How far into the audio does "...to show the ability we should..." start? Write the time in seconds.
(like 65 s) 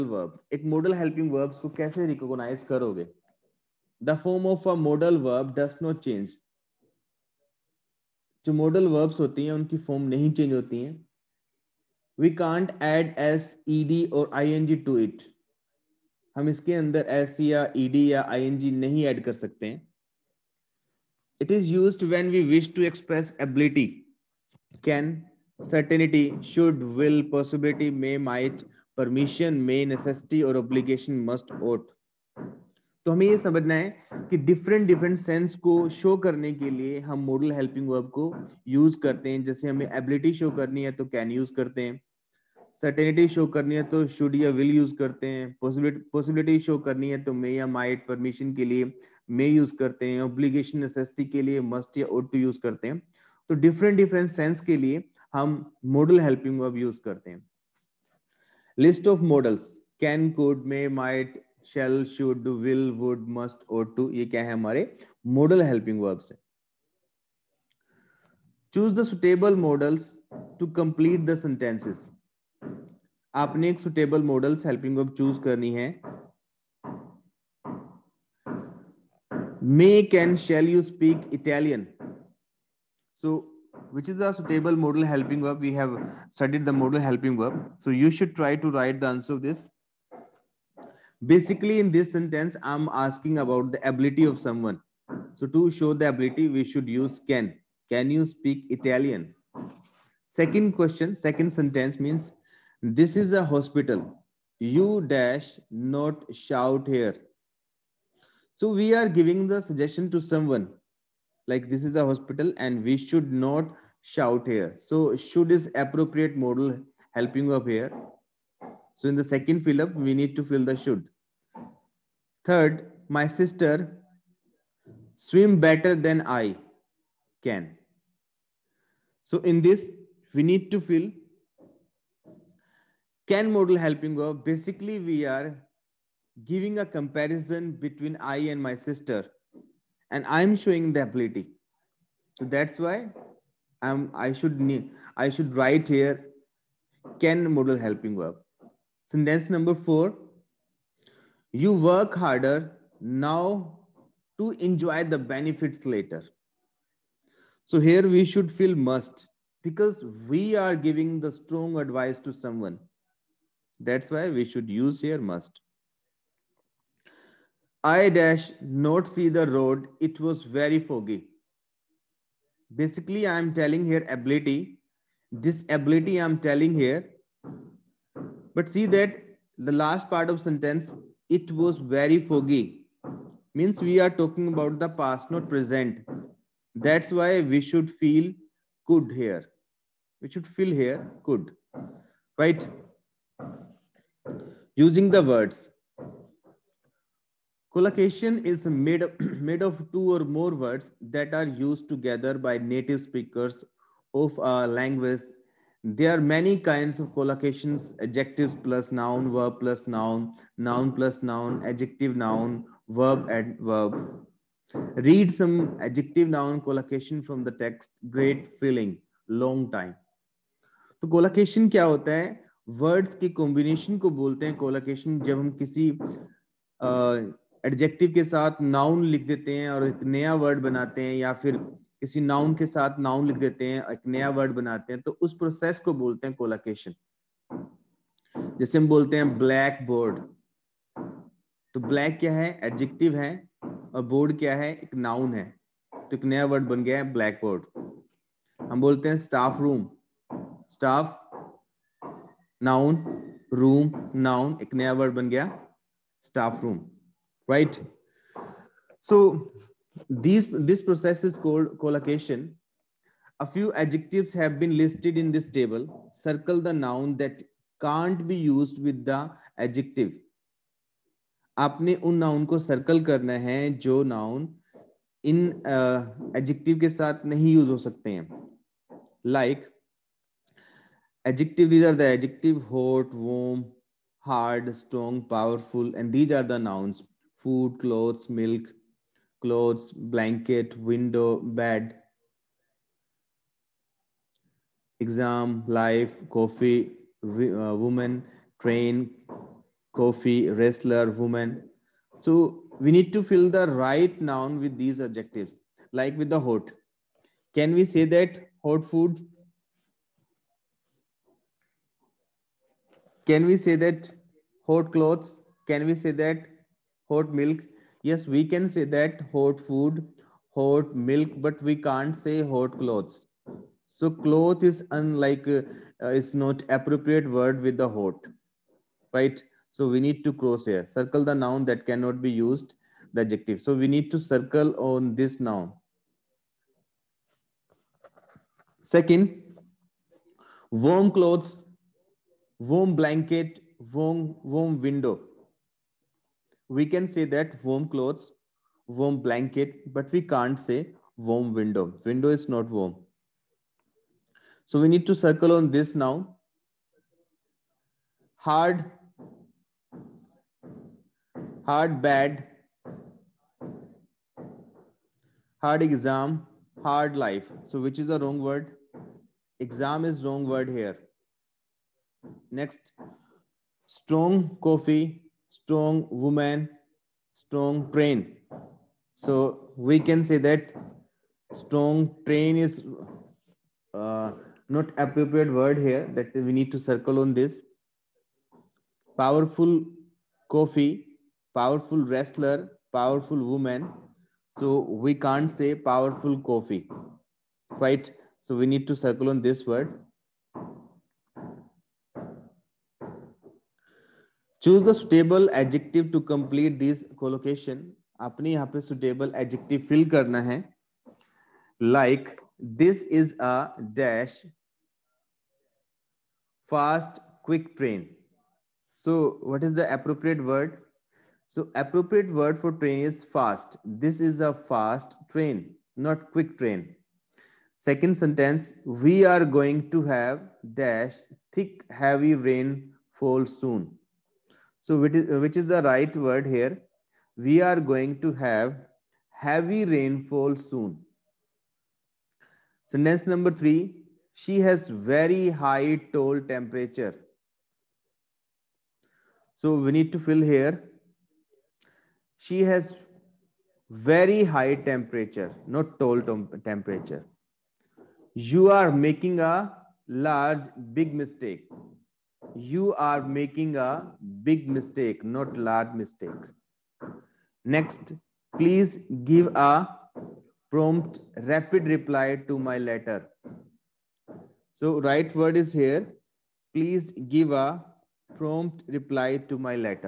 95 s.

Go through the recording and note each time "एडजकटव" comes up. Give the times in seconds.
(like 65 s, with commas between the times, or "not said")
227 s, 242 s.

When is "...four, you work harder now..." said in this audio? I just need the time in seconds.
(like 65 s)
149 s.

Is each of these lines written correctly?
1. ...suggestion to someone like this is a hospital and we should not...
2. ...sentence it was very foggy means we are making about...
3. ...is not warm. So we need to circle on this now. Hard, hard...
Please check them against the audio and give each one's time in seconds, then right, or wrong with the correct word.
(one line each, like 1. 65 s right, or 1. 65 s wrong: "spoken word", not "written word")
1. 109 s right
2. 180 s wrong: "talking", not "making"
3. 352 s right.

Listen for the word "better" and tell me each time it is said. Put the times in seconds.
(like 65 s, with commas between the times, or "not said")
125 s.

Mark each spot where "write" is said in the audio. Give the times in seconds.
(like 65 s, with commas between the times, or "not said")
88 s, 145 s.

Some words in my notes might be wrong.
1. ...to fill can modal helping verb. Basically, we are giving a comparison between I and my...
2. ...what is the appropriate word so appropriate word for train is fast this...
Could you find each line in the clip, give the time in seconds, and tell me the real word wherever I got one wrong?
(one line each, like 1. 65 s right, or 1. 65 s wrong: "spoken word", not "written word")
1. 130 s right
2. 419 s right.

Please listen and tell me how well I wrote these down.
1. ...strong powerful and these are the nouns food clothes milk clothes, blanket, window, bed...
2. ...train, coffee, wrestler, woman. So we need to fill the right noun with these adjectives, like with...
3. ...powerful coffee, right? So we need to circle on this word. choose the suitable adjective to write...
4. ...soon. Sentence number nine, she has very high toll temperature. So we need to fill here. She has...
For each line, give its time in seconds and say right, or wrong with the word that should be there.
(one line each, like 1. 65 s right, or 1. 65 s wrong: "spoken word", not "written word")
1. 284 s right
2. 298 s right
3. 395 s wrong: "complete", not "write"
4. 440 s wrong: "three", not "nine".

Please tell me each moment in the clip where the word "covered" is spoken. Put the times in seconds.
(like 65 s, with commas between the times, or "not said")
not said.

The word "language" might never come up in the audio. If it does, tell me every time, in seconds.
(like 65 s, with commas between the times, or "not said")
204 s.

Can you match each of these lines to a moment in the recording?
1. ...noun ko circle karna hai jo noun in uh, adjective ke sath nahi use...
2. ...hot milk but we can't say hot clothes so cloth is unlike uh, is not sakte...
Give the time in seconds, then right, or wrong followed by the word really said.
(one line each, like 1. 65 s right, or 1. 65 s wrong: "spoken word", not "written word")
1. 272 s right
2. 320 s wrong: "appropriate", not "sakte".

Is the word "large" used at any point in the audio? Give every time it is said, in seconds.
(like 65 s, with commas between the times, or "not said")
460 s, 465 s.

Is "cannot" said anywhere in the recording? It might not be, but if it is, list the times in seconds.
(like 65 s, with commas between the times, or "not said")
331 s.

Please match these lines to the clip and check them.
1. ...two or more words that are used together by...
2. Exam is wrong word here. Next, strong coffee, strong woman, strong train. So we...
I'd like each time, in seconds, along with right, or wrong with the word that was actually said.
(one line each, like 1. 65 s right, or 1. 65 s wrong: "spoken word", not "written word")
1. 199 s right
2. 369 s right.